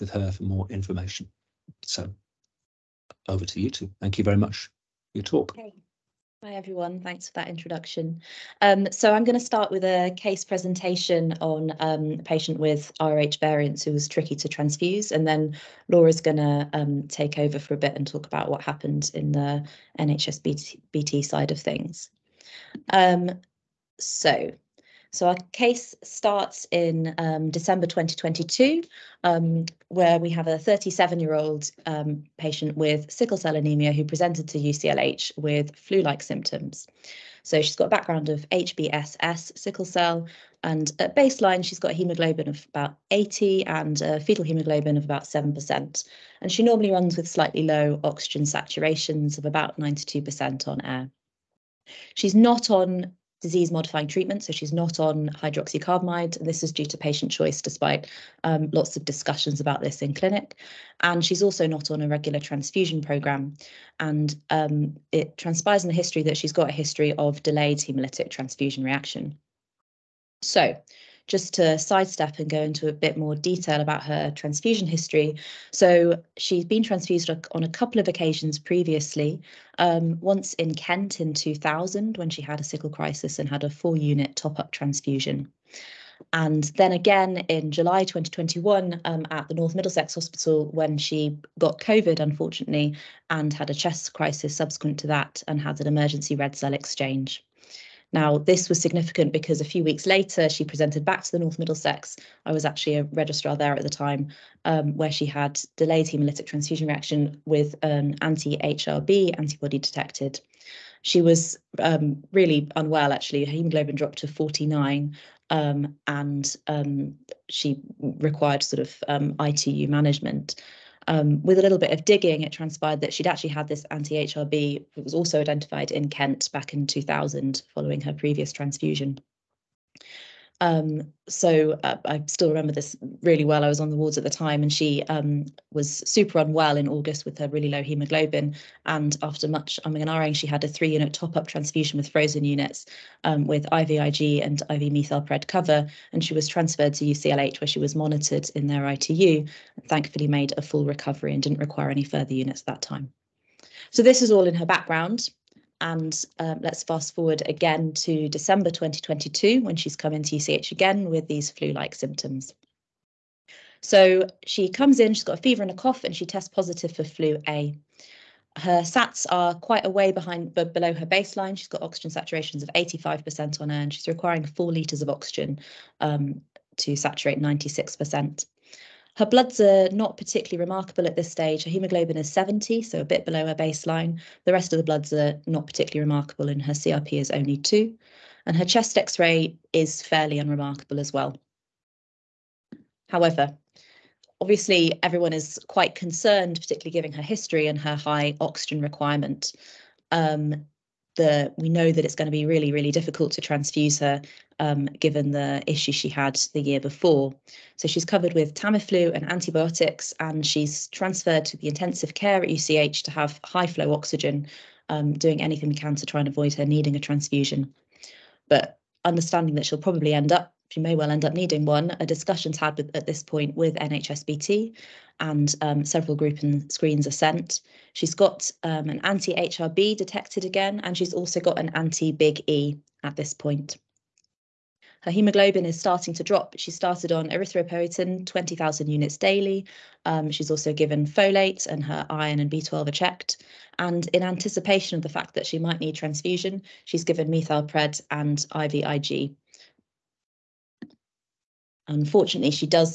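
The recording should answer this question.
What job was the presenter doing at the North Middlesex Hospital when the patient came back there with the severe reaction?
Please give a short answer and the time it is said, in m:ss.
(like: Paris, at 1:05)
Registrar, at 1:43.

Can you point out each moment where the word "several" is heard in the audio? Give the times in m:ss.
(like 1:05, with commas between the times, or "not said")
3:45.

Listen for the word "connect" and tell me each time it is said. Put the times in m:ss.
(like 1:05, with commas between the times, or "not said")
not said.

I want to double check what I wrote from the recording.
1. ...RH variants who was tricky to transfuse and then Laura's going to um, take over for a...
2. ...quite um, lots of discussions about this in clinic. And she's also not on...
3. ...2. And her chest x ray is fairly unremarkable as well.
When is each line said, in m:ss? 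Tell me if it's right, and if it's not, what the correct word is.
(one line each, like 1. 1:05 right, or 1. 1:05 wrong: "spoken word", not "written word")
1. 0:13 right
2. 0:57 wrong: "despite", not "quite"
3. 3:07 right.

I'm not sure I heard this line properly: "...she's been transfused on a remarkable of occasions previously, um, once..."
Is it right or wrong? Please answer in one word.
wrong.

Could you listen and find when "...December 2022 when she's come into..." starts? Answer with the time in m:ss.
2:38.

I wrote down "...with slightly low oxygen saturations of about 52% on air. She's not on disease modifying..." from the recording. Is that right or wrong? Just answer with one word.
wrong.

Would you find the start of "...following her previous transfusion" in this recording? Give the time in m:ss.
2:07.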